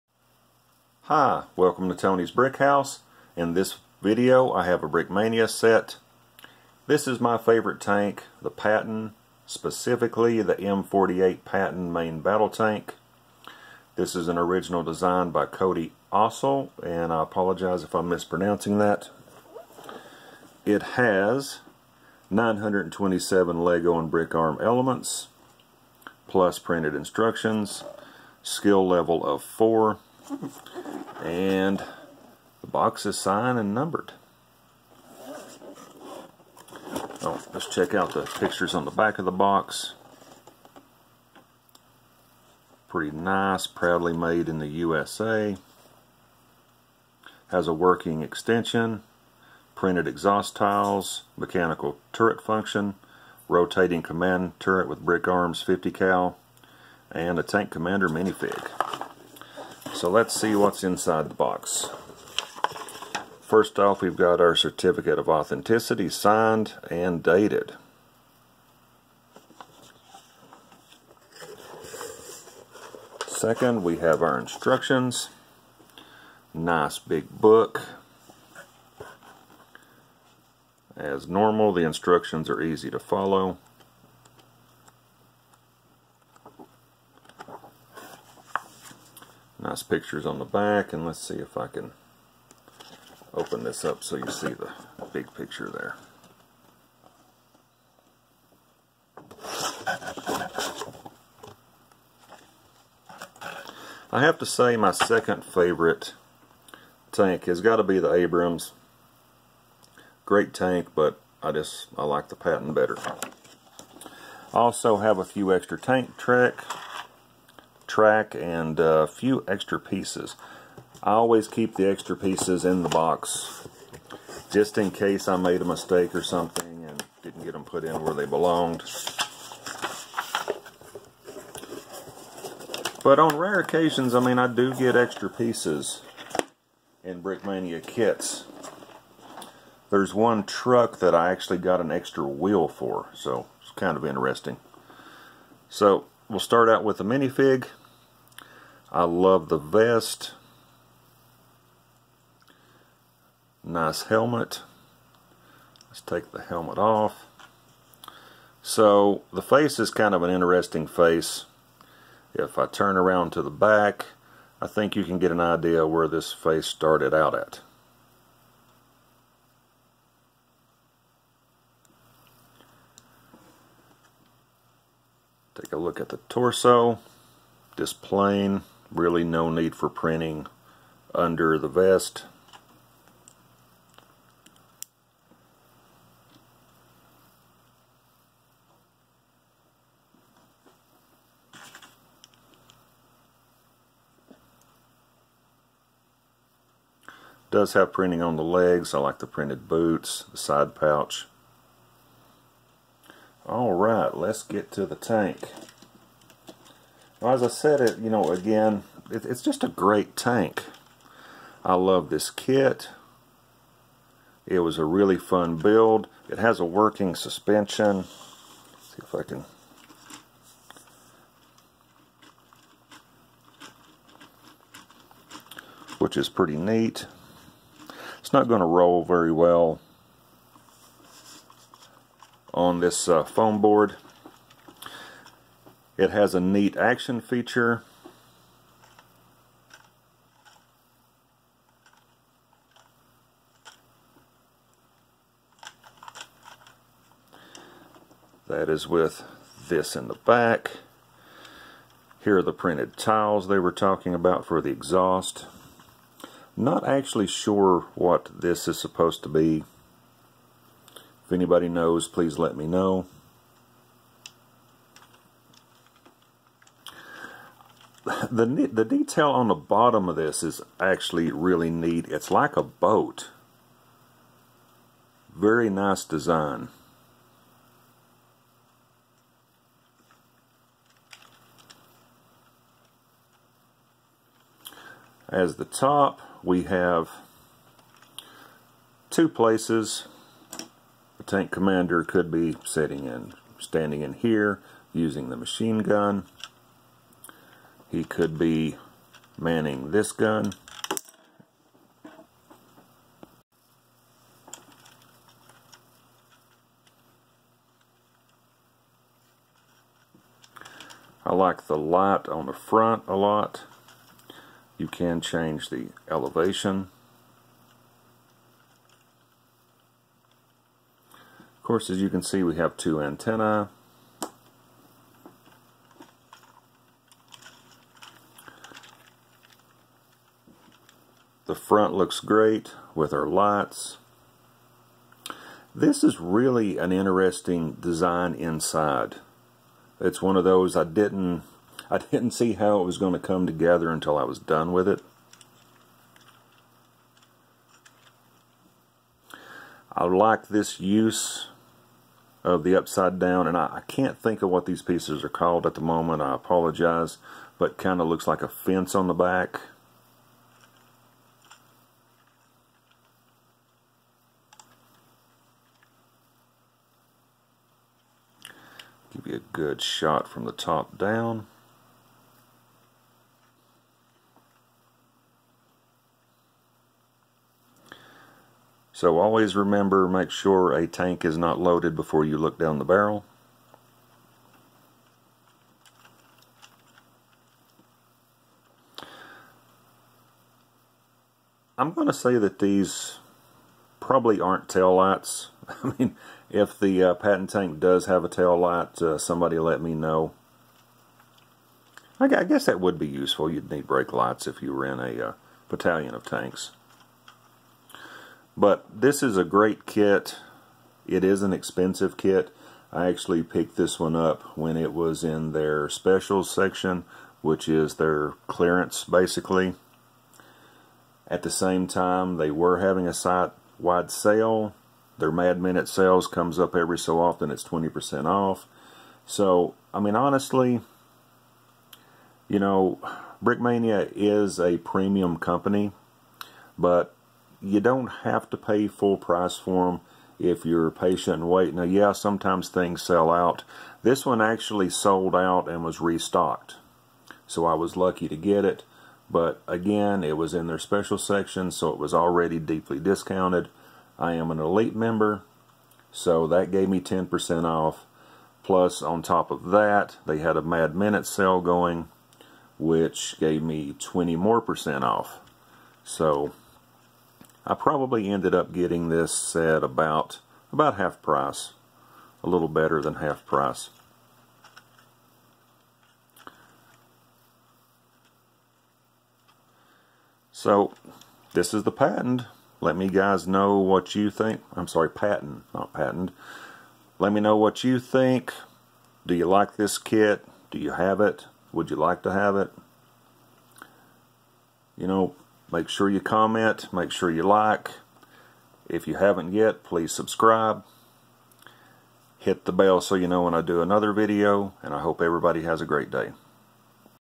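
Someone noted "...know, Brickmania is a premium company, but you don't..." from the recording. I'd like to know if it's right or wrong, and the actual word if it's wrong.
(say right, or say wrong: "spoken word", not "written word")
right.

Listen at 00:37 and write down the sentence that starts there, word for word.
Oh, let's check out the pictures on the back of the box.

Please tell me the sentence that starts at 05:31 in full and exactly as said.
The front looks great with our lights.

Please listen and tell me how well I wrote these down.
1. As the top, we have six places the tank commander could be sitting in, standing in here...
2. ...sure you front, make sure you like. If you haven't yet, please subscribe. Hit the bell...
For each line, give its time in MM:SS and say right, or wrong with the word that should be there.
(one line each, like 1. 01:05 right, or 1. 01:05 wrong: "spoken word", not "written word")
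1. 04:45 wrong: "two", not "six"
2. 08:15 wrong: "comment", not "front".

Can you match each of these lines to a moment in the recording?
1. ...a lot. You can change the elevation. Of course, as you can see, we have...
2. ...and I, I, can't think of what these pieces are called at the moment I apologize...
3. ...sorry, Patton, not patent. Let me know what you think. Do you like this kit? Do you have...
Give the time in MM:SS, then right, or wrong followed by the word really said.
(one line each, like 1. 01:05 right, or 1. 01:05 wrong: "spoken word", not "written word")
1. 05:13 right
2. 05:53 right
3. 08:04 right.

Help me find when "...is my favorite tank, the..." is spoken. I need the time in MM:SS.
00:07.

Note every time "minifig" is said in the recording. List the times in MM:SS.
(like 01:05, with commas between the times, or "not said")
00:58, 02:27.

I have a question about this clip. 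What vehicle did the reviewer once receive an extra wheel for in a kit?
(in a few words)
truck.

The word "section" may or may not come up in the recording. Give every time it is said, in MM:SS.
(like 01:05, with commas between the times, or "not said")
06:56, 07:31.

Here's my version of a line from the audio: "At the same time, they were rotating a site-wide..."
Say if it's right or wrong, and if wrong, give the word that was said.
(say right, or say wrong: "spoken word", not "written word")
wrong: "having", not "rotating".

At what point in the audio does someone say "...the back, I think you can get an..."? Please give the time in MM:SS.
02:43.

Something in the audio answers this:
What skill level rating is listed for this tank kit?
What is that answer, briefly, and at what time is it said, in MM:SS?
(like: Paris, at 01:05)
4, at 00:28.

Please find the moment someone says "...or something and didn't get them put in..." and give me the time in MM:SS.
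02:06.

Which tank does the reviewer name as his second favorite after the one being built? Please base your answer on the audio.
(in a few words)
Abrams.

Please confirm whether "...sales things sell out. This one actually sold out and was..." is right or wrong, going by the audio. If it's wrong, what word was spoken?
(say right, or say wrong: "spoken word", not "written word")
wrong: "sometimes", not "sales".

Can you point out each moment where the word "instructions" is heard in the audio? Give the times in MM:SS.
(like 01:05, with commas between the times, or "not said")
00:26, 01:14, 01:21.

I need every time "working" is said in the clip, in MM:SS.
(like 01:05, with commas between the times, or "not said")
00:47, 03:36.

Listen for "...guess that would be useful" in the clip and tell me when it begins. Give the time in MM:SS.
06:42.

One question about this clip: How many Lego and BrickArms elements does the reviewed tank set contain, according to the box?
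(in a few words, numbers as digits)
927.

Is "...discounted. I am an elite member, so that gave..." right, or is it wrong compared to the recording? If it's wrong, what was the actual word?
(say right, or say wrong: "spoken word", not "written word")
right.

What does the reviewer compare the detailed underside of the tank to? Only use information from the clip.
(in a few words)
a boat.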